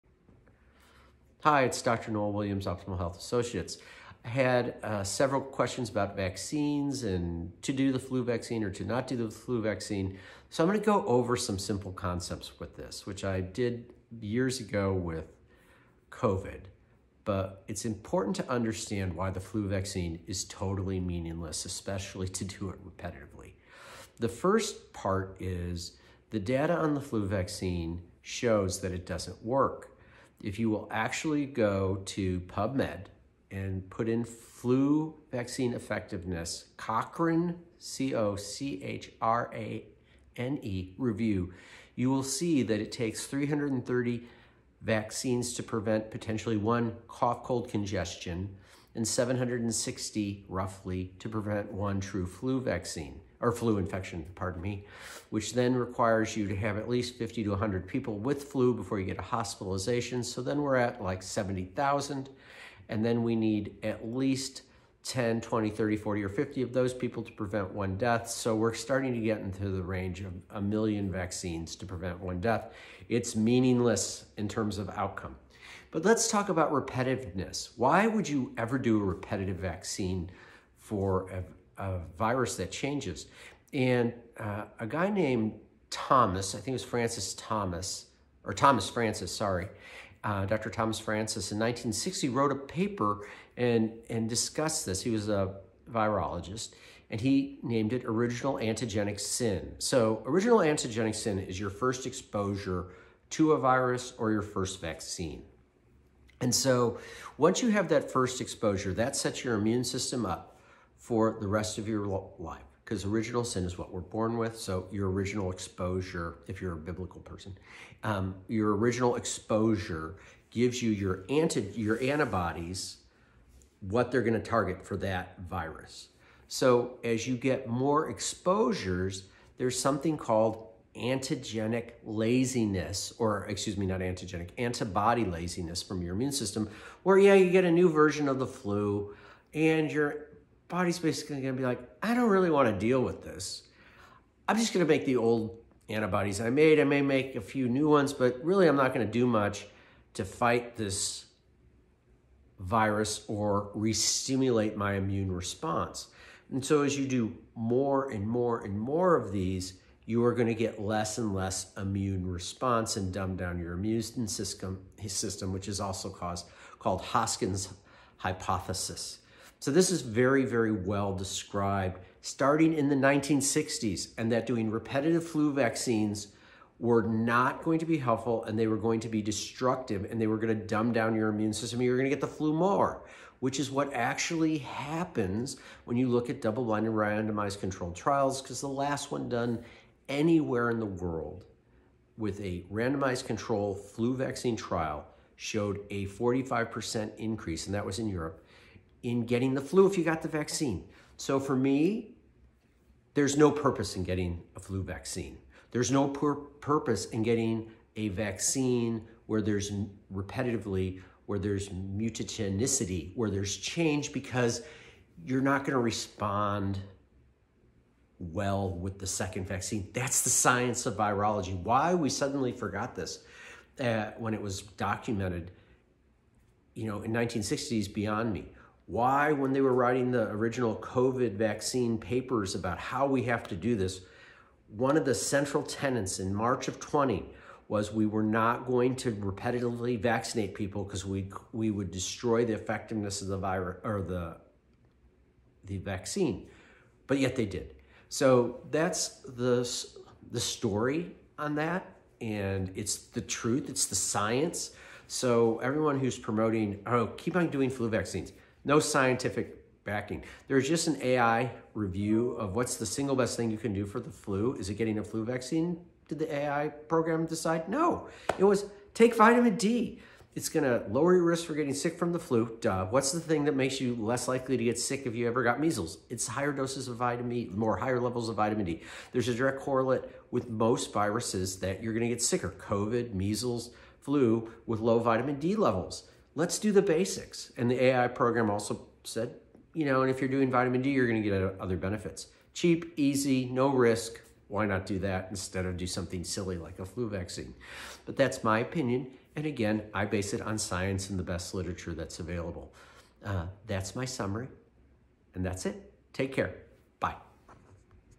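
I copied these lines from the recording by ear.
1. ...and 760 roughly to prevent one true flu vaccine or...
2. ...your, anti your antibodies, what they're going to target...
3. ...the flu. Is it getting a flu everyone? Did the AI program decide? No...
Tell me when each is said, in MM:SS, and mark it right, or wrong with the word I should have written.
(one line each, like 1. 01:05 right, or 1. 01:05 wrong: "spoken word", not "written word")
1. 00:48 right
2. 02:00 right
3. 04:24 wrong: "vaccine", not "everyone".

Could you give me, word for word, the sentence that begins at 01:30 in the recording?
Thomas Francis in 1960 wrote a paper and, and discussed this.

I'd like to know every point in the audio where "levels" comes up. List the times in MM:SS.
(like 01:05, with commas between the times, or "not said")
04:37, 04:45.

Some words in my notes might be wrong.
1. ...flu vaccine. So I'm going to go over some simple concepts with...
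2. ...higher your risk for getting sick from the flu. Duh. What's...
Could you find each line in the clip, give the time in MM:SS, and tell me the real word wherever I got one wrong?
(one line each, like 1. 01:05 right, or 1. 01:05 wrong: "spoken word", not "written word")
1. 00:09 right
2. 04:30 wrong: "lower", not "higher".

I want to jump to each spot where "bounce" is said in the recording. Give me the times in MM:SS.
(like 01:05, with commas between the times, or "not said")
not said.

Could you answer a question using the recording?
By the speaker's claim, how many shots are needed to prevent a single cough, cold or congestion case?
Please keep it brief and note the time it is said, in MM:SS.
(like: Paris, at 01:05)
330, at 00:43.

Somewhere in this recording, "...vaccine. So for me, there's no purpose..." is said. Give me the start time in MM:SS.
03:20.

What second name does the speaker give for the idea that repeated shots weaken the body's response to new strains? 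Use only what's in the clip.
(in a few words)
Hoskins hypothesis.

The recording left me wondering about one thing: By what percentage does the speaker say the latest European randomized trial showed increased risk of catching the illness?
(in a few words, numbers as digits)
45%.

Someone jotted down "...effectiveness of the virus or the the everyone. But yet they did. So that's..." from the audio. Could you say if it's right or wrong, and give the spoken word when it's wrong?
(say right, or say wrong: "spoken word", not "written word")
wrong: "vaccine", not "everyone".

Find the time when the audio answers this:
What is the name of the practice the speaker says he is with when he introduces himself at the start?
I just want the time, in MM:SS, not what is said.
00:02.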